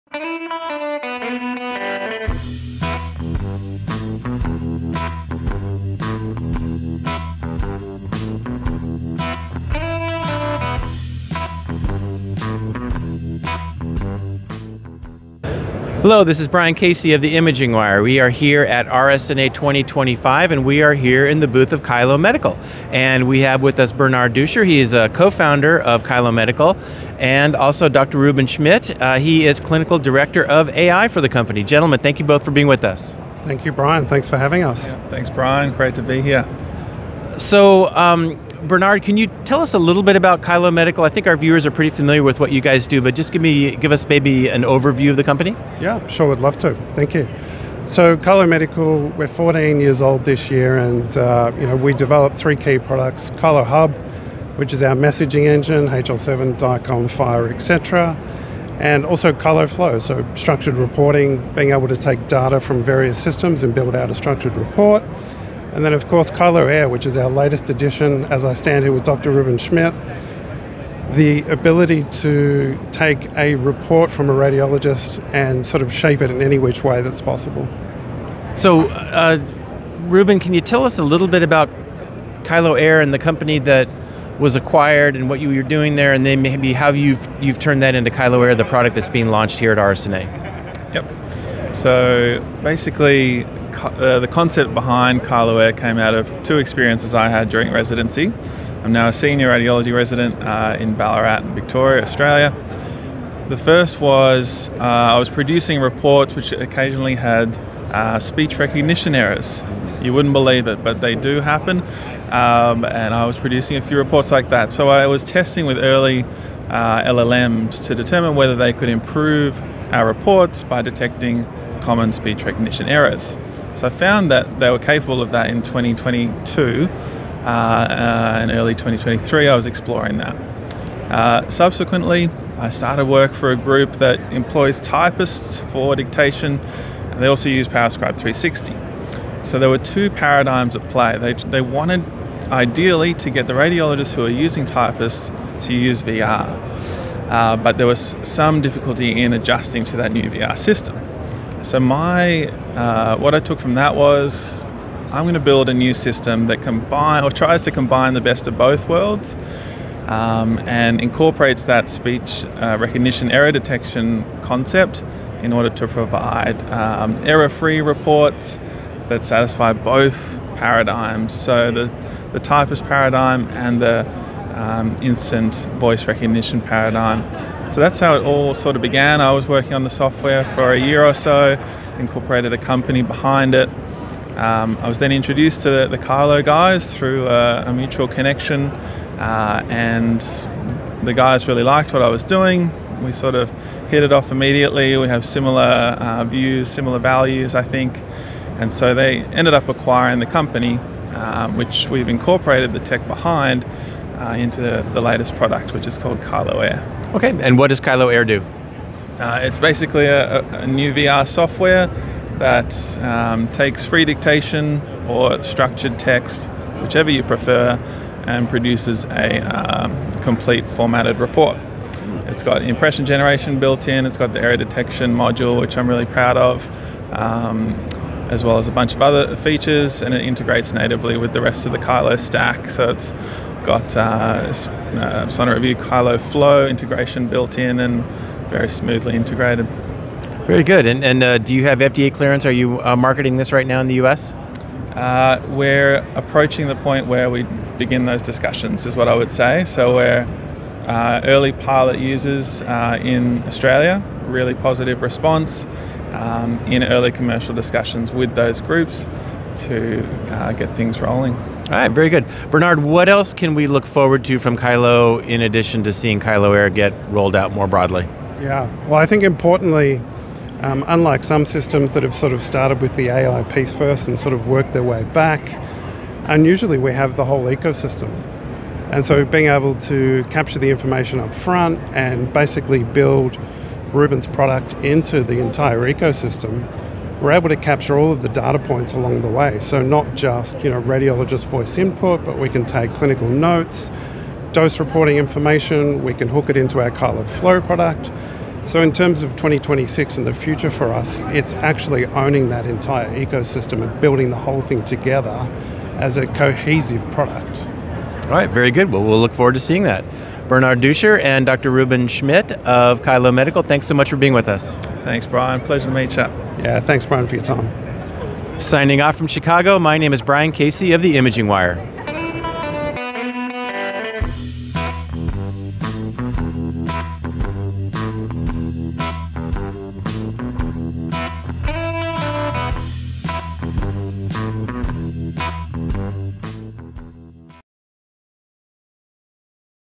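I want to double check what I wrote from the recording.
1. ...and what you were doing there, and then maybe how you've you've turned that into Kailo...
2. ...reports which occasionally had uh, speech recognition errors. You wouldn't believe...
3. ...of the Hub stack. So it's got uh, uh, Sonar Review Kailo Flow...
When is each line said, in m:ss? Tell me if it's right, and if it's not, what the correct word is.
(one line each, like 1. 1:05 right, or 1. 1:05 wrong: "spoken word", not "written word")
1. 1:25 right
2. 1:45 right
3. 3:51 wrong: "Kailo", not "Hub".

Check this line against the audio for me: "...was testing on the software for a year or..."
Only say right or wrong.
wrong.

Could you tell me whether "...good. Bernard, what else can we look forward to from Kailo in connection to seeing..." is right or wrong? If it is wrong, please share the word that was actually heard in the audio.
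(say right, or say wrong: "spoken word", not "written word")
wrong: "addition", not "connection".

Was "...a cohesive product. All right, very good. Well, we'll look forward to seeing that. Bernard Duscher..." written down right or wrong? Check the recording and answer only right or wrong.
right.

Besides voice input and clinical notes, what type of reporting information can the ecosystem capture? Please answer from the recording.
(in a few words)
Dose reporting.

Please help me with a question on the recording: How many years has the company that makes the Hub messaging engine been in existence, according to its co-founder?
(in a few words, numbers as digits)
14.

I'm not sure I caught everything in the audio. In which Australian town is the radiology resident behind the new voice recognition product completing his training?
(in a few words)
Ballarat.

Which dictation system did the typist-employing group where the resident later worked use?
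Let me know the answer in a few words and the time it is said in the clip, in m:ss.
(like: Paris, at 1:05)
PowerScribe 360, at 2:17.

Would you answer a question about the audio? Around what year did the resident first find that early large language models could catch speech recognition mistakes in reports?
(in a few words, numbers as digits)
2022.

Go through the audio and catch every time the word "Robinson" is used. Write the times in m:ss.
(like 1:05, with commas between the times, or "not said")
not said.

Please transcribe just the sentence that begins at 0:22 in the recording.
And we have with us Bernard Duscher.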